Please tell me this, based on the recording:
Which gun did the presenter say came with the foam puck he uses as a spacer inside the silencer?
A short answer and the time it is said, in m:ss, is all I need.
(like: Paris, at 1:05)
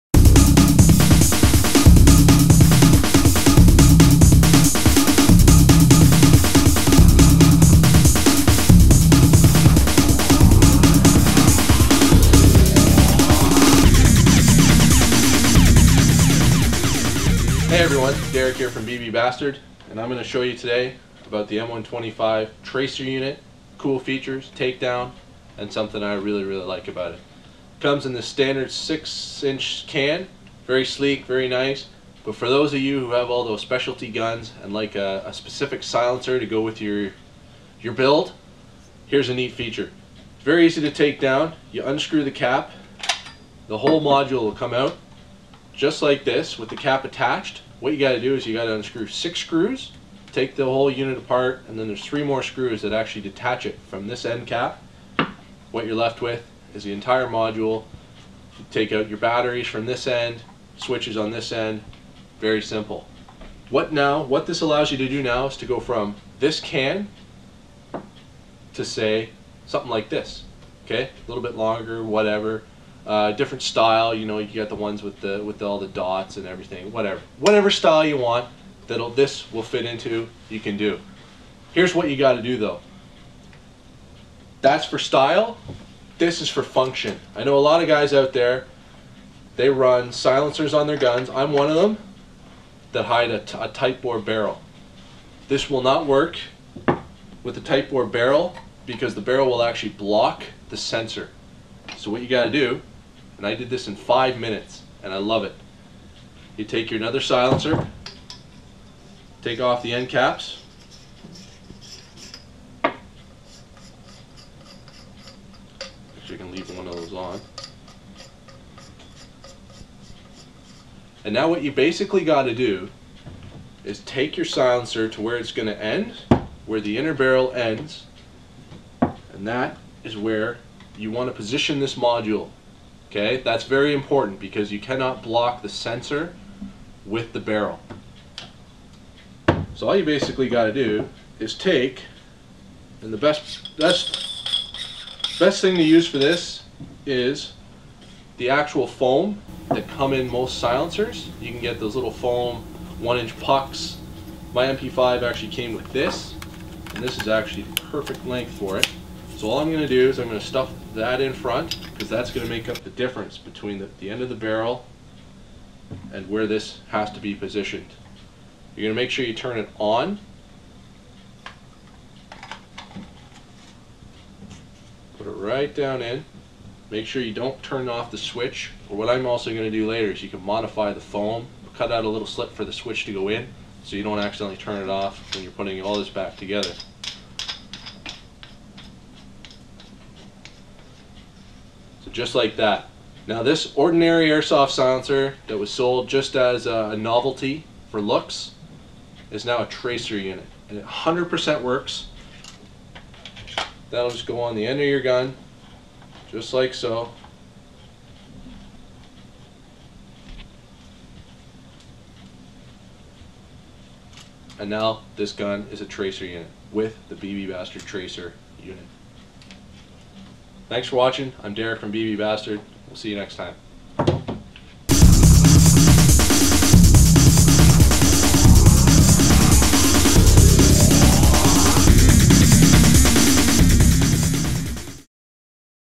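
MP5, at 2:34.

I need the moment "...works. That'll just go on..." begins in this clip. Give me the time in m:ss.
3:21.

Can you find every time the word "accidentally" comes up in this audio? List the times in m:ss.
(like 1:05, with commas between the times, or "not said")
3:04.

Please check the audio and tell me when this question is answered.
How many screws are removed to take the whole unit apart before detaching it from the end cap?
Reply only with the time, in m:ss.
0:49.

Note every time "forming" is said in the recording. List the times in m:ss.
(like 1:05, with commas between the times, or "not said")
not said.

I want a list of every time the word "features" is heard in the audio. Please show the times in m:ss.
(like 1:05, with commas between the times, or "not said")
0:23, 0:39.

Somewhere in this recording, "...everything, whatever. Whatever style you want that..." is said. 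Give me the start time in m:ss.
1:16.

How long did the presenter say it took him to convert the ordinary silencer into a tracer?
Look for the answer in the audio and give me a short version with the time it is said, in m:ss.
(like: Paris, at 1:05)
5 minutes, at 1:43.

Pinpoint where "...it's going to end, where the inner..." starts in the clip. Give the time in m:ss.
2:05.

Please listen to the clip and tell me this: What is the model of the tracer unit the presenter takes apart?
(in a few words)
M125.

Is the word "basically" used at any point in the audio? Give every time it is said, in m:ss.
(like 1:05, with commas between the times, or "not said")
2:01, 2:20.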